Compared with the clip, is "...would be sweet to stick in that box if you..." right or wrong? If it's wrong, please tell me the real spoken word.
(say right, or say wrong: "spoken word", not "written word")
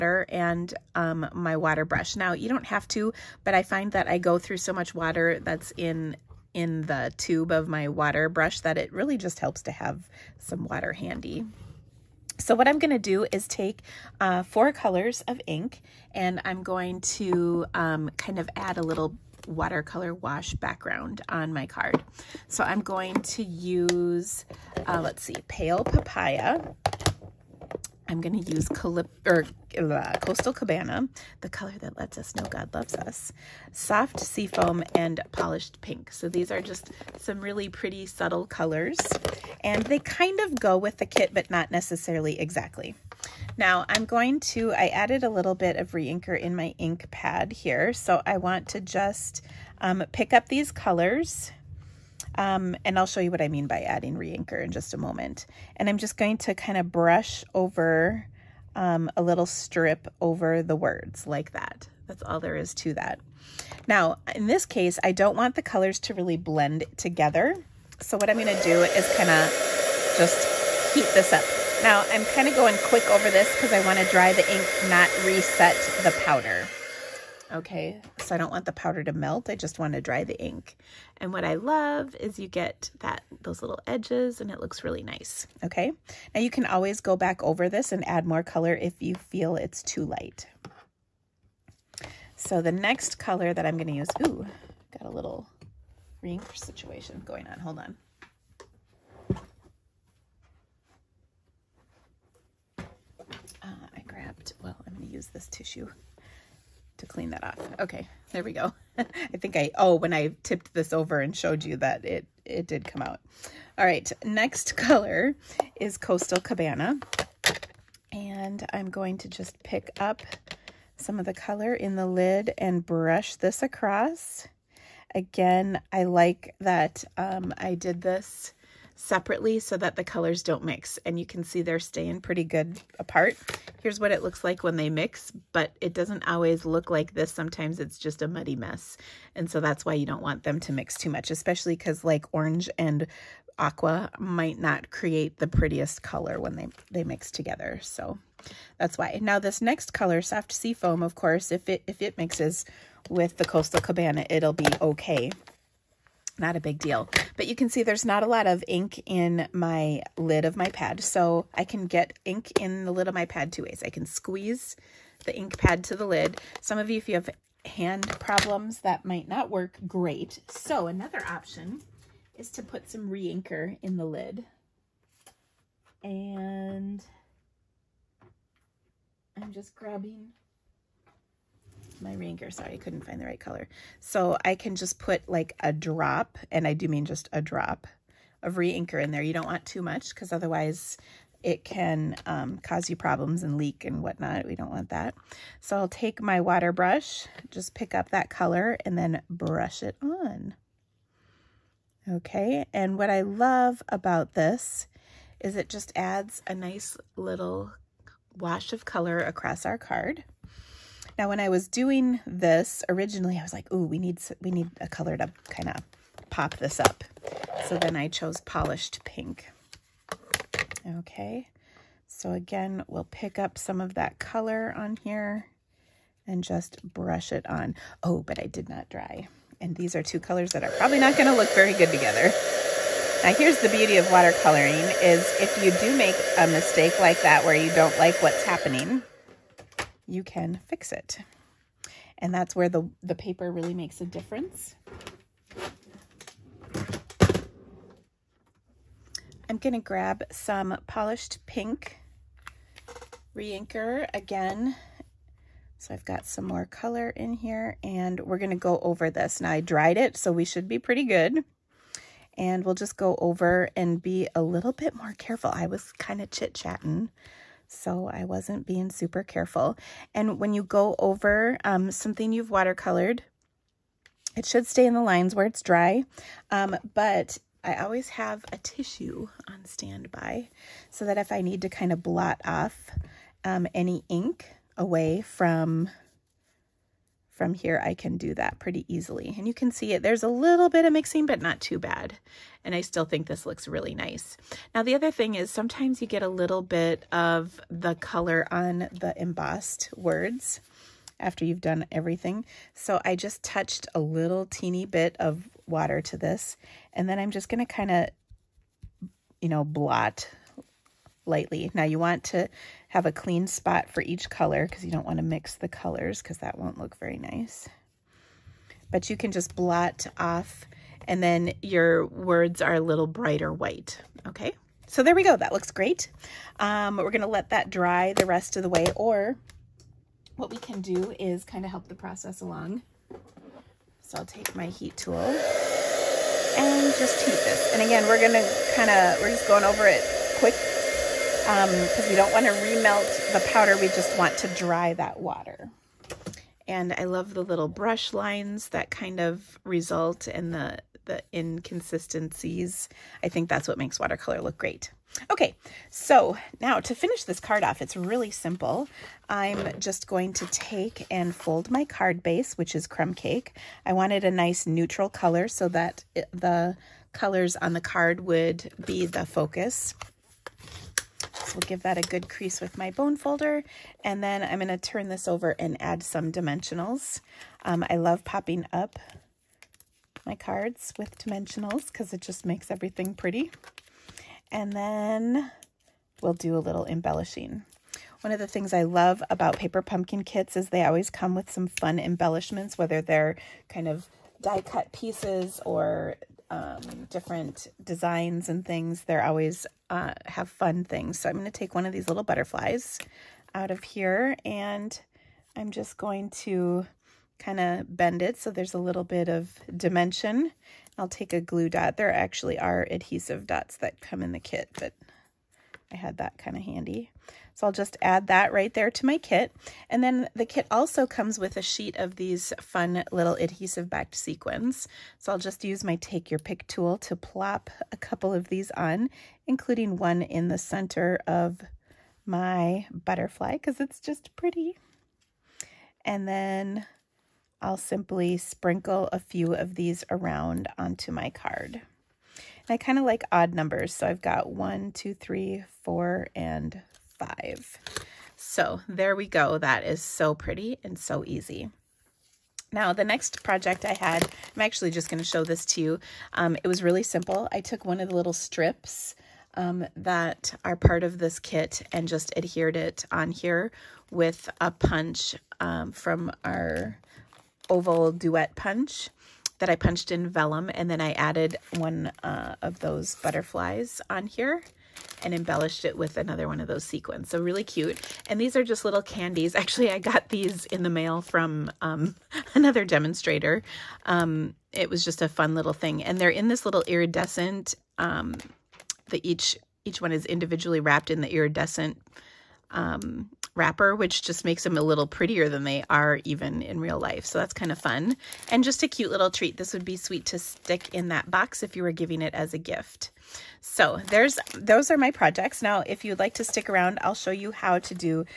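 right.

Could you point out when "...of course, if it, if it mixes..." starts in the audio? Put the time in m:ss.
2:31.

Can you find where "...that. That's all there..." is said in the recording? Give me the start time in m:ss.
1:01.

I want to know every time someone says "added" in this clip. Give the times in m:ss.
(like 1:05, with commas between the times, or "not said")
0:44, 7:51.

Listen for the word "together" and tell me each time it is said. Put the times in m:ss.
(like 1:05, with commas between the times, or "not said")
1:06, 2:27, 3:51.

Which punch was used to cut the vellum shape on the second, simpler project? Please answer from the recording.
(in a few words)
oval duet punch.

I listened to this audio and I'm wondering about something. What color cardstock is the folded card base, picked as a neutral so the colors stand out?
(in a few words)
Crumb Cake.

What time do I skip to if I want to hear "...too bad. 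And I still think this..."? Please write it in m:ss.
4:51.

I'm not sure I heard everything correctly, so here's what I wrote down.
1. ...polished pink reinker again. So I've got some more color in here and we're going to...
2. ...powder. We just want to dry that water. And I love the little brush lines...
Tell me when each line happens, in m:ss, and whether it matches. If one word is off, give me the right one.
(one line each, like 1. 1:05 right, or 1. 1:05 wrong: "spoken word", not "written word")
1. 4:10 right
2. 5:43 right.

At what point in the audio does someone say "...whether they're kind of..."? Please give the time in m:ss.
6:32.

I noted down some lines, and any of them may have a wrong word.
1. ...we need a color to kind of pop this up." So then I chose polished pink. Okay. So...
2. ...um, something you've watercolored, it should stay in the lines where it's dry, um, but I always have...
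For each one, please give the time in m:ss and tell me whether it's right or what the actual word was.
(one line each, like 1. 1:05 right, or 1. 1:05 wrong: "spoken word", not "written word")
1. 3:34 right
2. 4:31 right.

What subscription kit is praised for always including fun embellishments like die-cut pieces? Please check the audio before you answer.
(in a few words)
Paper Pumpkin.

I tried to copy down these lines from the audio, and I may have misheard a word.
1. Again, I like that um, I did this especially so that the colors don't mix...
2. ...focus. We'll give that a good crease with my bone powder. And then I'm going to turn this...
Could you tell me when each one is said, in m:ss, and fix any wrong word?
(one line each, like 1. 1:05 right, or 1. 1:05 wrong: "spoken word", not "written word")
1. 2:05 wrong: "separately", not "especially"
2. 6:09 wrong: "folder", not "powder".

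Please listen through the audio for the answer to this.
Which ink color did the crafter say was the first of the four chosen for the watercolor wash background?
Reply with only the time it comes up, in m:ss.
0:25.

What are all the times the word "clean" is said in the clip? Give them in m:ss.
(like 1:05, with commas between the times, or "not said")
1:47, 5:13.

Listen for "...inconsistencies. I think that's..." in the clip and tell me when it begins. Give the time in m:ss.
5:51.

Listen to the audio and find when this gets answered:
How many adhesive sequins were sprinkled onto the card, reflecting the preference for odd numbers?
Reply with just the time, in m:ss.
7:27.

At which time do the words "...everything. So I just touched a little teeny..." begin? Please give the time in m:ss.
5:01.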